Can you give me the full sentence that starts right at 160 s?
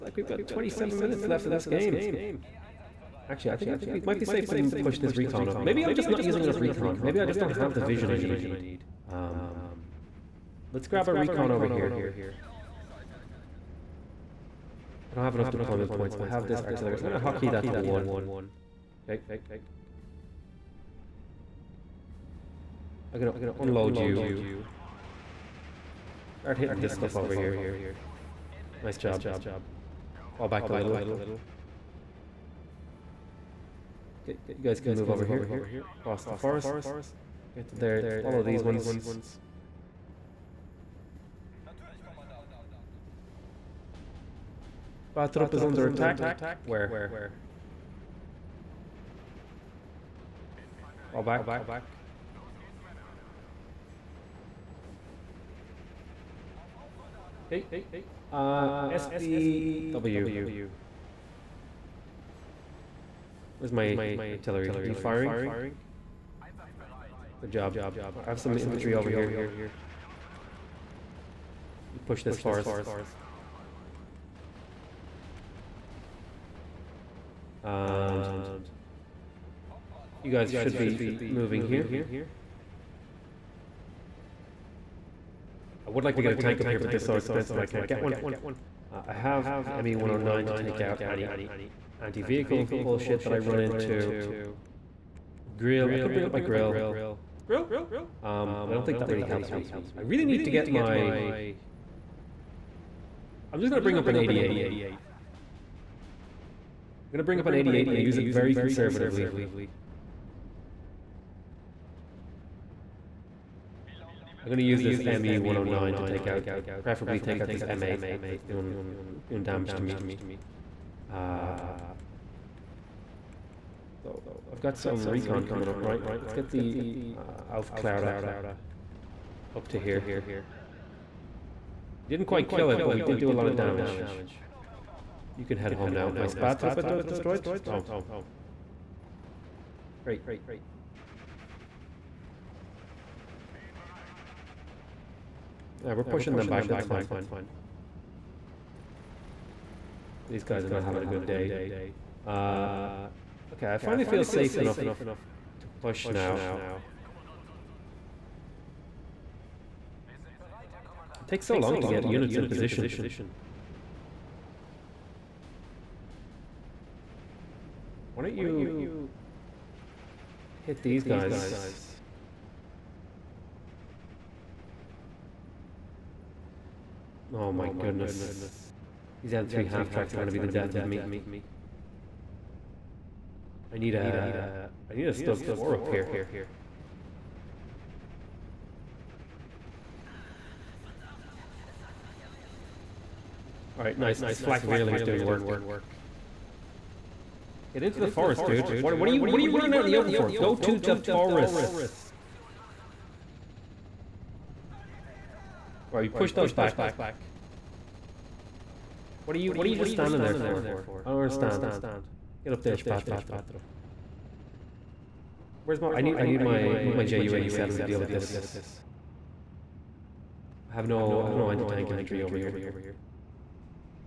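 It takes so long to get units in position.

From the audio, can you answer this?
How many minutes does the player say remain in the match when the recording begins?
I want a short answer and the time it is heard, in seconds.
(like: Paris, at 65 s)
27, at 0 s.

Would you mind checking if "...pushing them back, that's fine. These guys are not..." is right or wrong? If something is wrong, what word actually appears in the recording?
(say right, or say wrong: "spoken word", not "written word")
right.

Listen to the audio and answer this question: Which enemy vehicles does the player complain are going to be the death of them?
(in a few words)
M3 half-tracks.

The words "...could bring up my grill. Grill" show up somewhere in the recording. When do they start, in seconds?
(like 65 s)
95 s.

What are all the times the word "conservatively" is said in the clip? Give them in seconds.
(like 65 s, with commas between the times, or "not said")
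108 s.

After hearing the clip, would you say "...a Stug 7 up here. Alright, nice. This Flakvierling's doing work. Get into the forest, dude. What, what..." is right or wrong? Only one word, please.
wrong.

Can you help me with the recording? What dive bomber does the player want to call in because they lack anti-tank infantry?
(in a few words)
JU 87.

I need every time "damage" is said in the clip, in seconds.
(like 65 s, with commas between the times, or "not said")
119 s, 133 s.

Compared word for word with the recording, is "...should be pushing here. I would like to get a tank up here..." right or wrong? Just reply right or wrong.
wrong.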